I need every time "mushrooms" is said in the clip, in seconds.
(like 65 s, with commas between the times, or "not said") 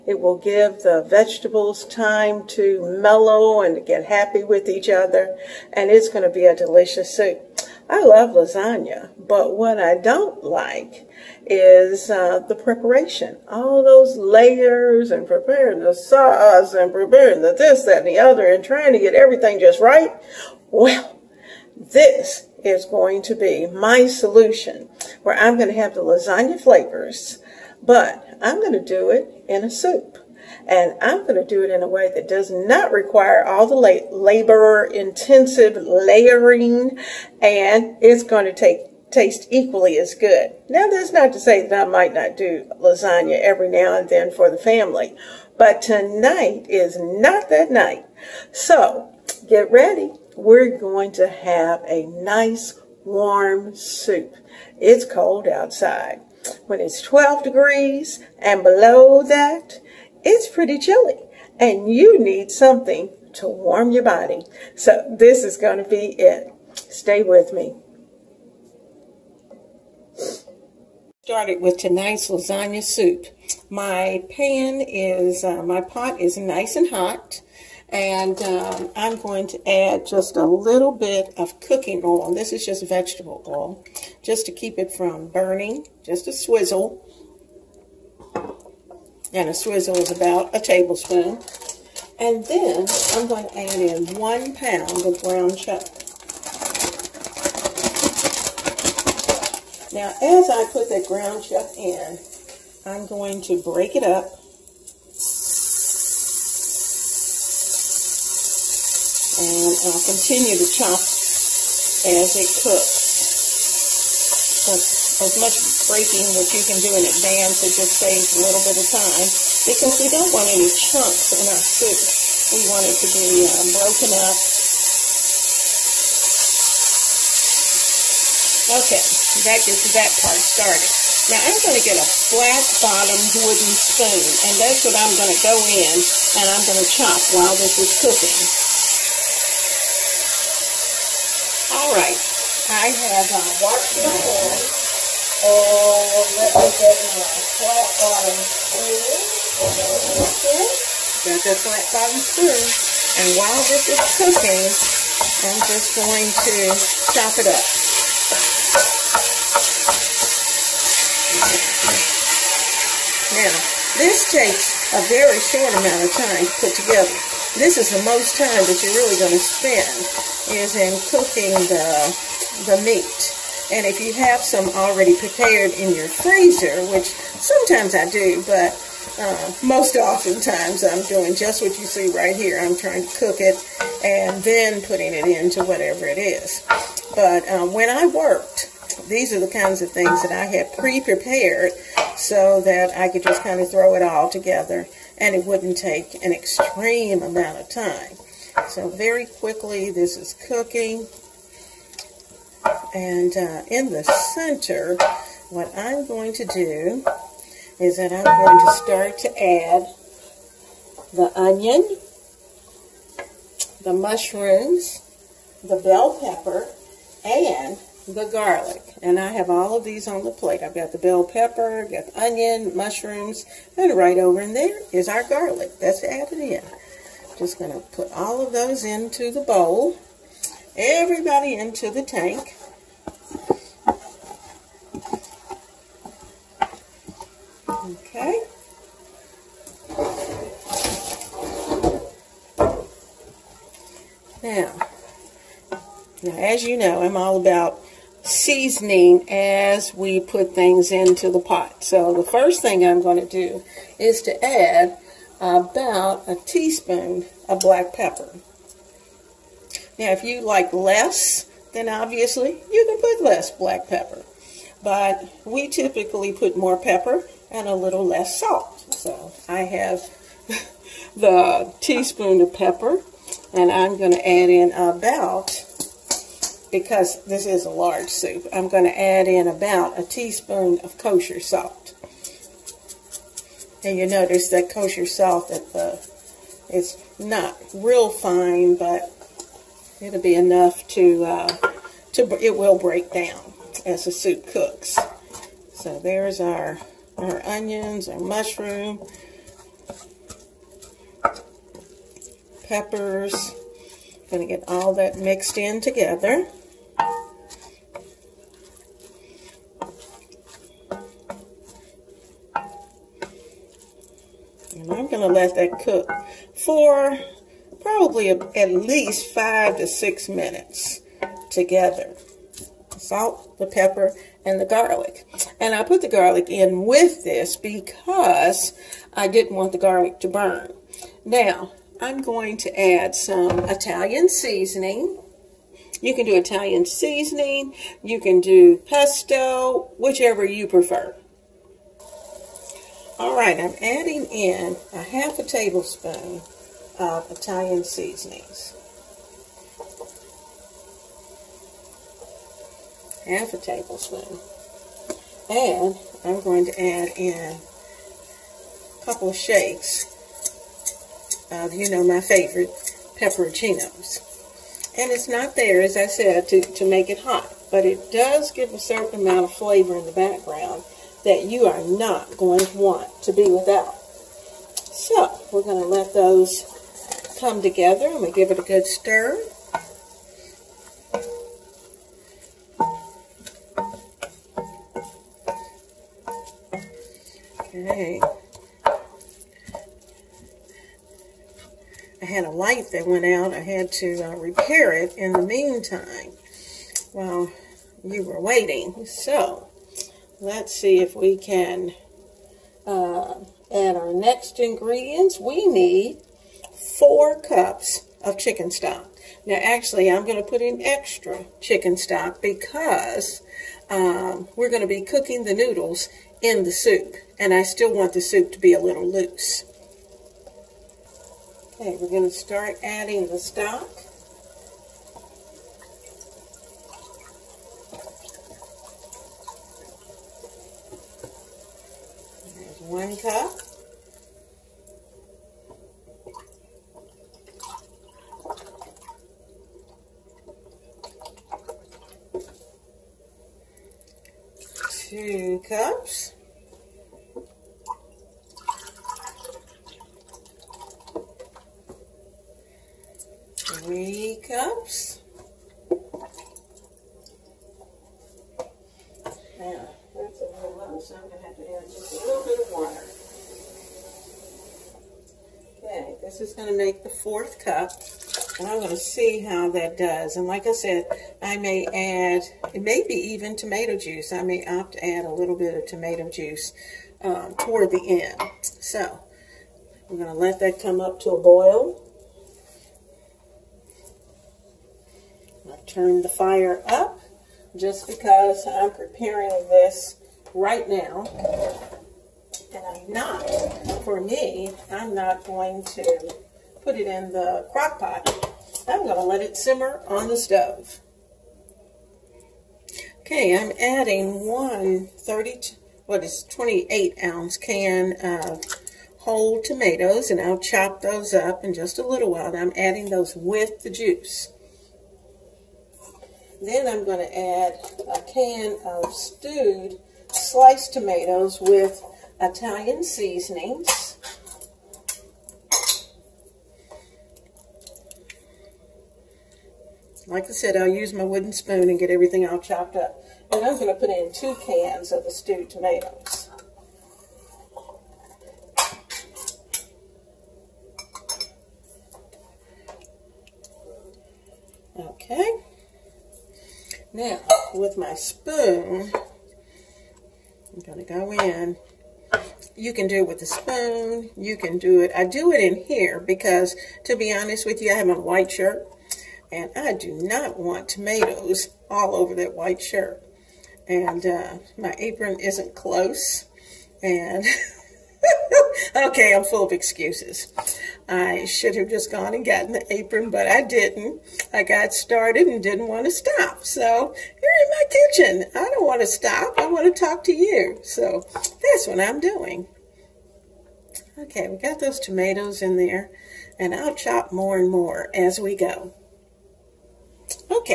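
213 s, 222 s, 298 s.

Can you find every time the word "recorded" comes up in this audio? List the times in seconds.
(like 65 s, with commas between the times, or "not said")
not said.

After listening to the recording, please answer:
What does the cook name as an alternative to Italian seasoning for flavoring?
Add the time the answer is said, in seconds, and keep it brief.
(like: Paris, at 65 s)
Pesto, at 338 s.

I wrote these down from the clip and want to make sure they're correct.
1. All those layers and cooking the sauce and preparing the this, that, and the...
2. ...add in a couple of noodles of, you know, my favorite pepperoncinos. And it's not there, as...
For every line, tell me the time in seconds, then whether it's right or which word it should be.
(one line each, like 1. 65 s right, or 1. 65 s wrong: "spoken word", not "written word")
1. 13 s wrong: "preparing", not "cooking"
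2. 356 s wrong: "shakes", not "noodles".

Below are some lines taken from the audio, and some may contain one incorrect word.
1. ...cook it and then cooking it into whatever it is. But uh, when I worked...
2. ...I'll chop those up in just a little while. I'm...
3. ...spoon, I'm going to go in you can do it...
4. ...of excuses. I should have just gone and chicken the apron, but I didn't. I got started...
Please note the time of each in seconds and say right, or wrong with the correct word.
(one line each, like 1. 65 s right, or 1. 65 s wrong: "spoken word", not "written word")
1. 183 s wrong: "putting", not "cooking"
2. 510 s right
3. 548 s right
4. 569 s wrong: "gotten", not "chicken".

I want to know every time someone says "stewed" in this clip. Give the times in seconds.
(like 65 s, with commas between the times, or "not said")
519 s, 535 s.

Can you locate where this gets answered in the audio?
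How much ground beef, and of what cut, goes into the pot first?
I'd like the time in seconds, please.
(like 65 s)
94 s.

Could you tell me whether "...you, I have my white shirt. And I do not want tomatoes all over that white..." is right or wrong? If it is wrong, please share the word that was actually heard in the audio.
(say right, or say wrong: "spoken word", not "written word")
right.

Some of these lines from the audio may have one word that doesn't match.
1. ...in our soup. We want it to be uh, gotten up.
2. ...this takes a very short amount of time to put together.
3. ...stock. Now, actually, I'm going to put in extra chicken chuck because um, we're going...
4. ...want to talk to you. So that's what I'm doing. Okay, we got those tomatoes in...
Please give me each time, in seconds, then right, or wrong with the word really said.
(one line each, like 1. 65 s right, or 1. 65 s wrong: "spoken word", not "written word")
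1. 121 s wrong: "broken", not "gotten"
2. 164 s right
3. 408 s wrong: "stock", not "chuck"
4. 579 s right.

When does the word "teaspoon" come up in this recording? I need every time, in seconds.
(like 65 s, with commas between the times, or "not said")
256 s, 271 s, 280 s.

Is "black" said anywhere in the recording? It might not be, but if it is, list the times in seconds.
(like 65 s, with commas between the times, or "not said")
257 s, 263 s.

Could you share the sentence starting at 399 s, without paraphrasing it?
So, let's see if we can uh, add our next ingredients.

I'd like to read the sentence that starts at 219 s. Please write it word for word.
And I have all of these on the plate.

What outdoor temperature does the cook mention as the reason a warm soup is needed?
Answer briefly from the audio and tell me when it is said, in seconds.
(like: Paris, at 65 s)
12 degrees, at 57 s.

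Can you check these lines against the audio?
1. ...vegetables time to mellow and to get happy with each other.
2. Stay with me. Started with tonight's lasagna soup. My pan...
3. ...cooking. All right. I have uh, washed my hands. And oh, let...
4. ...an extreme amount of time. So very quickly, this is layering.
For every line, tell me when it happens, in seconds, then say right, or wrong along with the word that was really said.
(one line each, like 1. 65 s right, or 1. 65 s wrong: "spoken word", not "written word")
1. 1 s right
2. 66 s right
3. 138 s right
4. 196 s wrong: "cooking", not "layering".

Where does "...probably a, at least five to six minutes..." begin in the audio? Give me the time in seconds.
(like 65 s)
317 s.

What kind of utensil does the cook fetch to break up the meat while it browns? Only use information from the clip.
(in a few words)
Flat bottomed wooden spoon.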